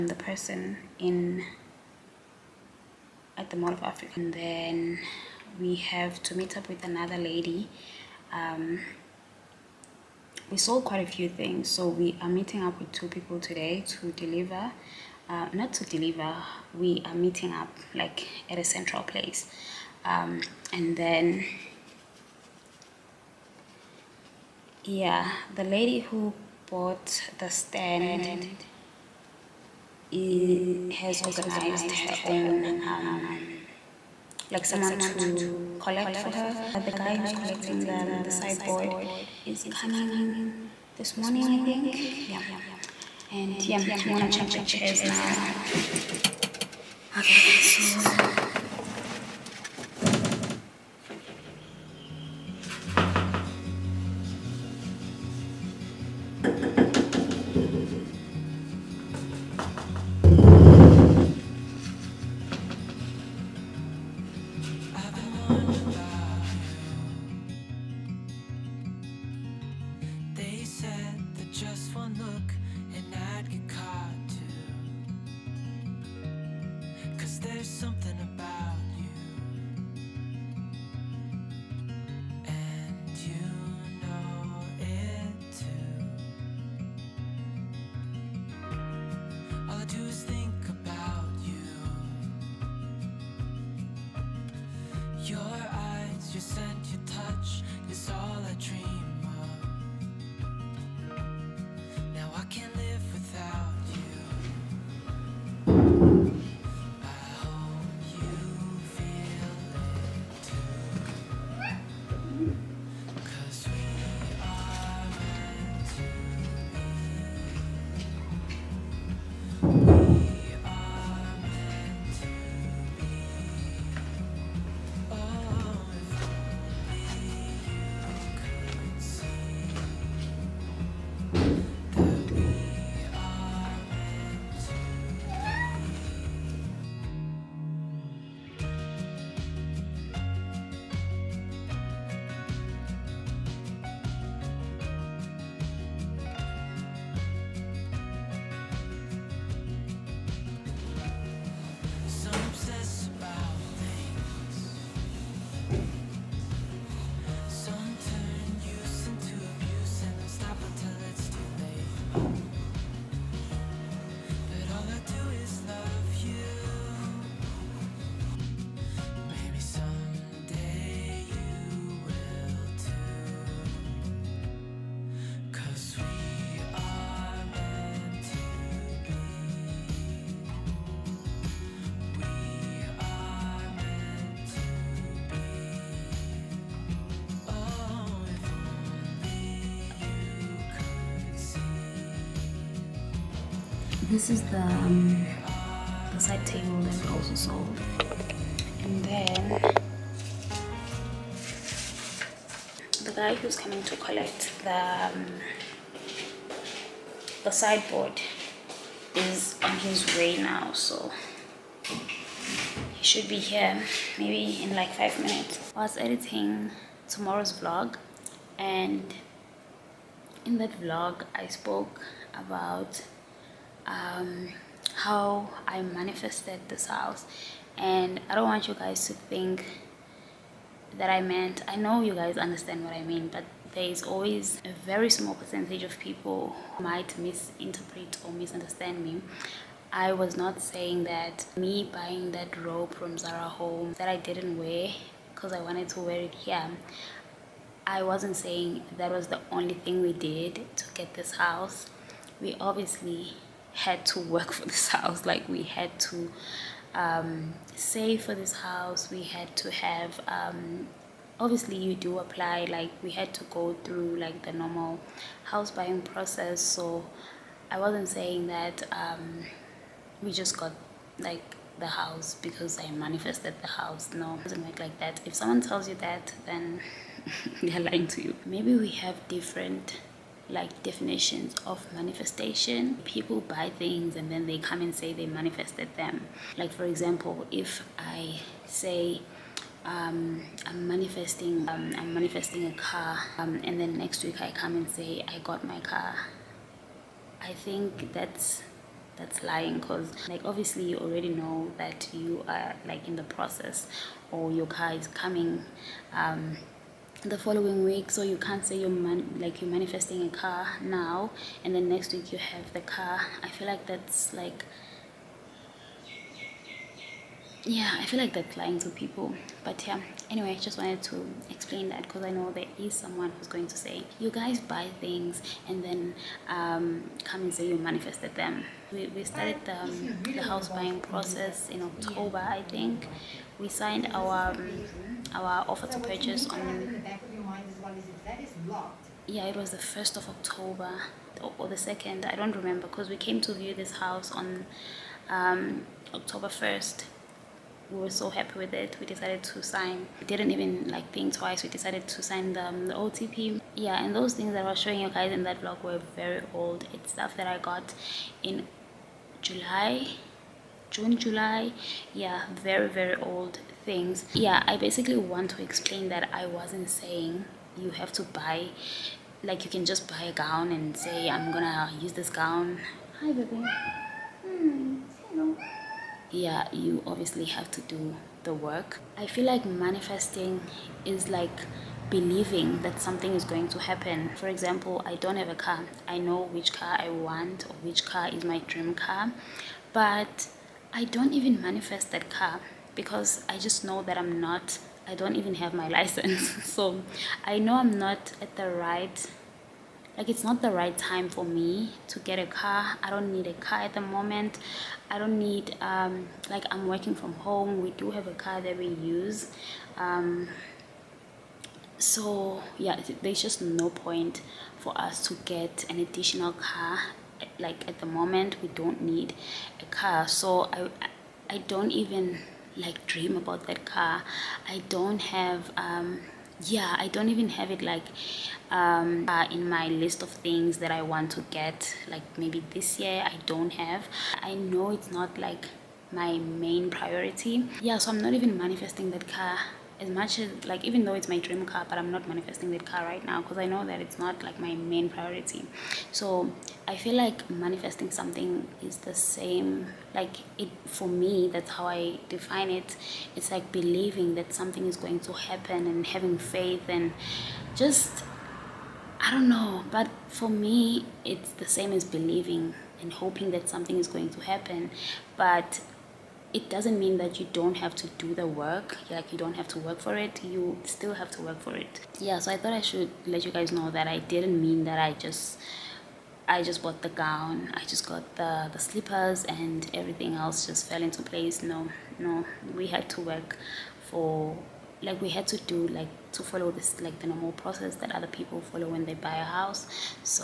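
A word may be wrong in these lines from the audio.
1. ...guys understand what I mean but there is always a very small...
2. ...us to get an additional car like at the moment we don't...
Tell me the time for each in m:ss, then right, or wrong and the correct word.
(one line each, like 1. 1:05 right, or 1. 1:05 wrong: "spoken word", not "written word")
1. 3:52 right
2. 6:54 right.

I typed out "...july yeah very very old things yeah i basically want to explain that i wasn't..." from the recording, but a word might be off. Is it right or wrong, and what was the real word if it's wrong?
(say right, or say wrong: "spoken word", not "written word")
right.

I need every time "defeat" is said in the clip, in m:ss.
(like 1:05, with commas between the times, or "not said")
not said.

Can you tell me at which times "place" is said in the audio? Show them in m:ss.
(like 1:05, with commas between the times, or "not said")
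0:19, 8:01.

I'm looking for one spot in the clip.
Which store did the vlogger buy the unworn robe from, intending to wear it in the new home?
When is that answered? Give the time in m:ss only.
4:03.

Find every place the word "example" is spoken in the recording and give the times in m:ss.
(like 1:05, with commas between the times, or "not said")
4:46, 6:24.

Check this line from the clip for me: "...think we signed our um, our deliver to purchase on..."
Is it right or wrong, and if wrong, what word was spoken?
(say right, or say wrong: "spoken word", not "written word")
wrong: "offer", not "deliver".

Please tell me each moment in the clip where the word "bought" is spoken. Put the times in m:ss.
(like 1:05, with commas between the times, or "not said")
0:26, 7:56.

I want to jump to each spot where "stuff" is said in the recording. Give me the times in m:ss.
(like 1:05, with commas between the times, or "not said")
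5:57.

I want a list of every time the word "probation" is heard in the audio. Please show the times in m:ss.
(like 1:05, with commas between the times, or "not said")
not said.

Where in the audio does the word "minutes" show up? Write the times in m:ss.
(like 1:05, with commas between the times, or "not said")
3:35.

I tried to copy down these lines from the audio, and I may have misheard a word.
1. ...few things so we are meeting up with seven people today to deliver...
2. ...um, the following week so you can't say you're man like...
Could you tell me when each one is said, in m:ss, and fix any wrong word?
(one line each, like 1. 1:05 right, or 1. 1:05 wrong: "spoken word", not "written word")
1. 0:11 wrong: "two", not "seven"
2. 5:06 right.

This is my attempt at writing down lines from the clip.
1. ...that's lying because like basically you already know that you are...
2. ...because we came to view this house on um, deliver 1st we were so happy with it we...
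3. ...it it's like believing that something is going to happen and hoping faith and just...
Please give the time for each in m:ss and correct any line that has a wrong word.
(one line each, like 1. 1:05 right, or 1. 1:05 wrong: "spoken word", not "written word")
1. 4:59 wrong: "obviously", not "basically"
2. 5:42 wrong: "october", not "deliver"
3. 7:32 wrong: "having", not "hoping".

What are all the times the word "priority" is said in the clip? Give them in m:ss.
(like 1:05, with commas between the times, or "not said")
7:16, 7:25.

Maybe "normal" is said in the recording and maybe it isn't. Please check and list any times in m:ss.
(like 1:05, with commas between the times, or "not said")
4:24, 8:07.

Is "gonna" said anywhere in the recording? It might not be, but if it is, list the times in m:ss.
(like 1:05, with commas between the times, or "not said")
0:44, 6:11.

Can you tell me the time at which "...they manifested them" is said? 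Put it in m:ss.
4:45.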